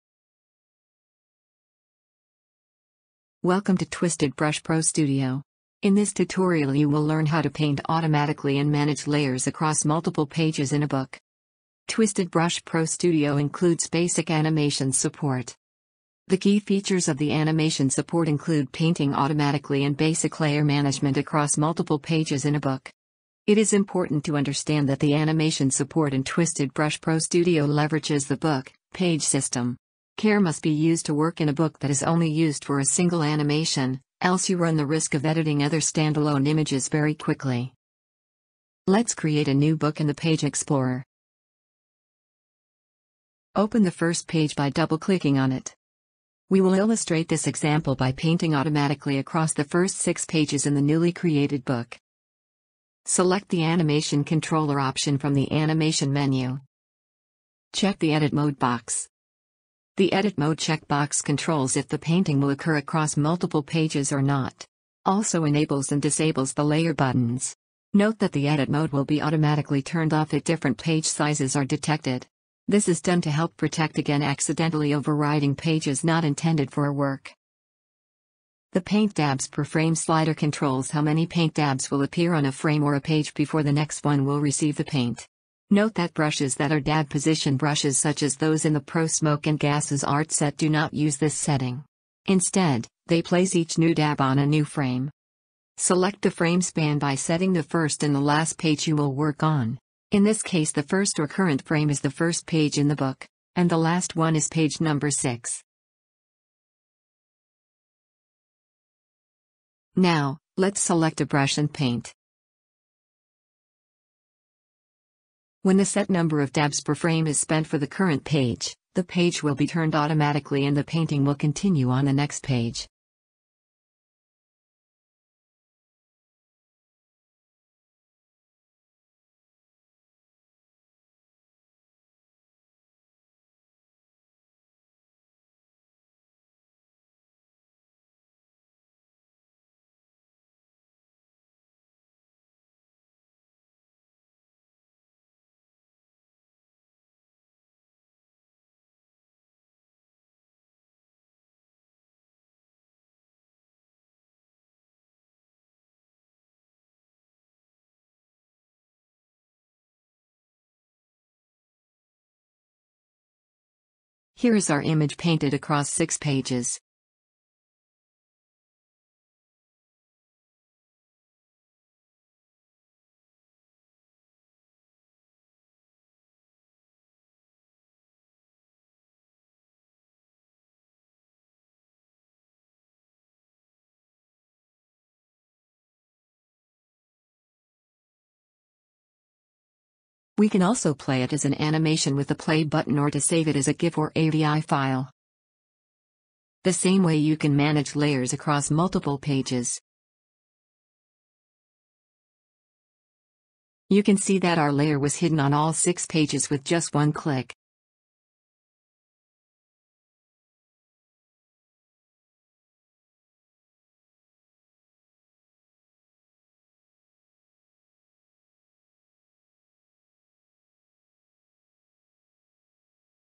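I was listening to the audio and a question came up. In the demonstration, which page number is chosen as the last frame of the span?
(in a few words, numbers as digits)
6.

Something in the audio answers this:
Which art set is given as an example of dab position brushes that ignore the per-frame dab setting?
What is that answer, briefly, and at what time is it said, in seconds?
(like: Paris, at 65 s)
Pro Smoke and Gases, at 88 s.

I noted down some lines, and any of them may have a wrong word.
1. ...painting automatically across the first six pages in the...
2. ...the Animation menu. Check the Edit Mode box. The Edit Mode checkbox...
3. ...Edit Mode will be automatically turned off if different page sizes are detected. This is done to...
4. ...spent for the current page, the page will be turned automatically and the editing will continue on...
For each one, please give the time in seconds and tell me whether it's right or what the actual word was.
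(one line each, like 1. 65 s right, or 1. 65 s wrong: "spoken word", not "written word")
1. 48 s right
2. 55 s right
3. 68 s right
4. 117 s wrong: "painting", not "editing".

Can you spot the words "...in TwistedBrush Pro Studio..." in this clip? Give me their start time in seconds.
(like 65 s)
26 s.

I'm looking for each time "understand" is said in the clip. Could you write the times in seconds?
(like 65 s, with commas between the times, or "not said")
24 s.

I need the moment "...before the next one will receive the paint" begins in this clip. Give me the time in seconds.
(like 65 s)
83 s.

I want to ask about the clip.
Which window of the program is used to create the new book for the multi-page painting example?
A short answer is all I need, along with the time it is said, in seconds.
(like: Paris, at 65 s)
Page Explorer, at 40 s.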